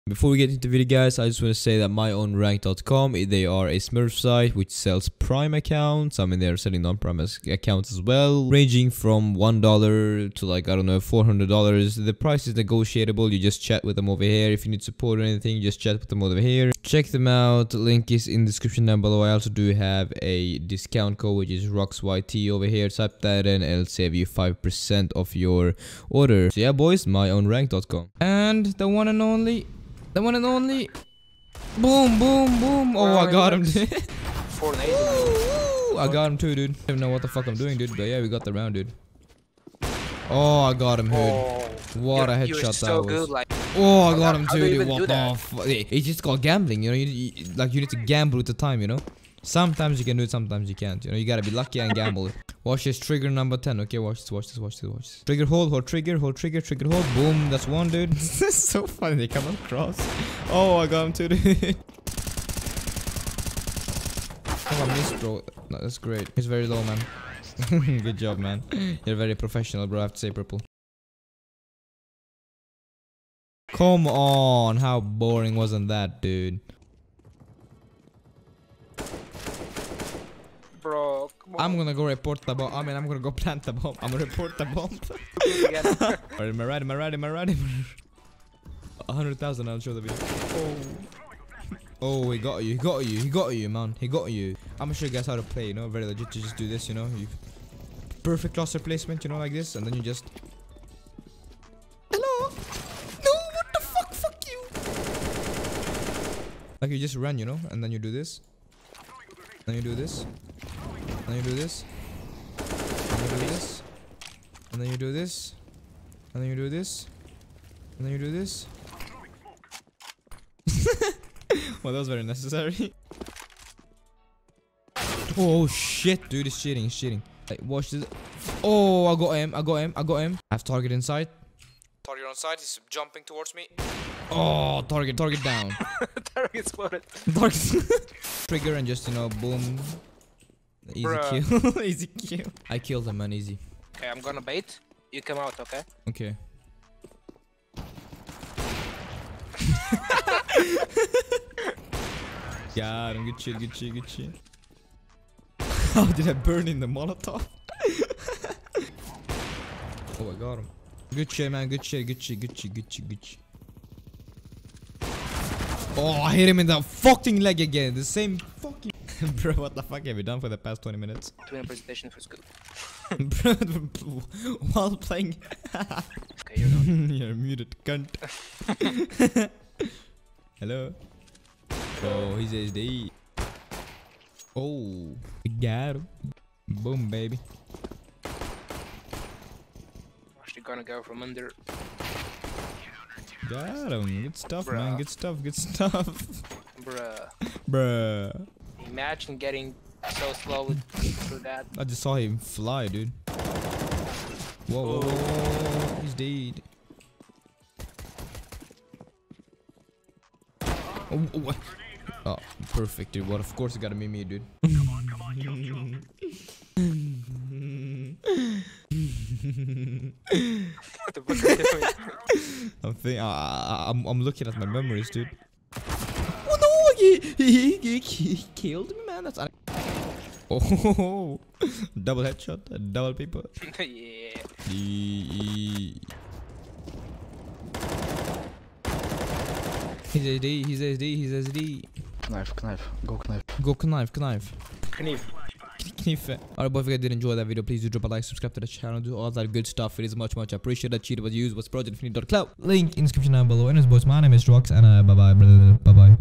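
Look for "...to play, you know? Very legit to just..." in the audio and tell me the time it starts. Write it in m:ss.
1:35.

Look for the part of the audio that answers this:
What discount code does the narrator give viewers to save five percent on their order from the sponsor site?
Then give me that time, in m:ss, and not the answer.
0:21.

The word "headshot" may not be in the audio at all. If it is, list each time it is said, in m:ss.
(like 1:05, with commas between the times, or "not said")
0:42, 3:52.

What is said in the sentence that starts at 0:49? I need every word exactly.
Sometimes you can do it, sometimes you can't.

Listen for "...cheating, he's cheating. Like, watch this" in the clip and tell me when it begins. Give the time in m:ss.
2:06.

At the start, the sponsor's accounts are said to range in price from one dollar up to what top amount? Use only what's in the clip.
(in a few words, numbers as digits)
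$400.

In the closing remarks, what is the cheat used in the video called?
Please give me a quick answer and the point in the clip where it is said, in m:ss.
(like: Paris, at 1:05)
Cloud, at 4:11.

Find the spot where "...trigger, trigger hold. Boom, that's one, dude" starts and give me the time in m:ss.
0:56.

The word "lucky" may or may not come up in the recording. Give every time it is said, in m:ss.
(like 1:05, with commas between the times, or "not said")
0:51.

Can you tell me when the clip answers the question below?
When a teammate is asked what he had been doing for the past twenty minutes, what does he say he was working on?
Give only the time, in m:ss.
2:51.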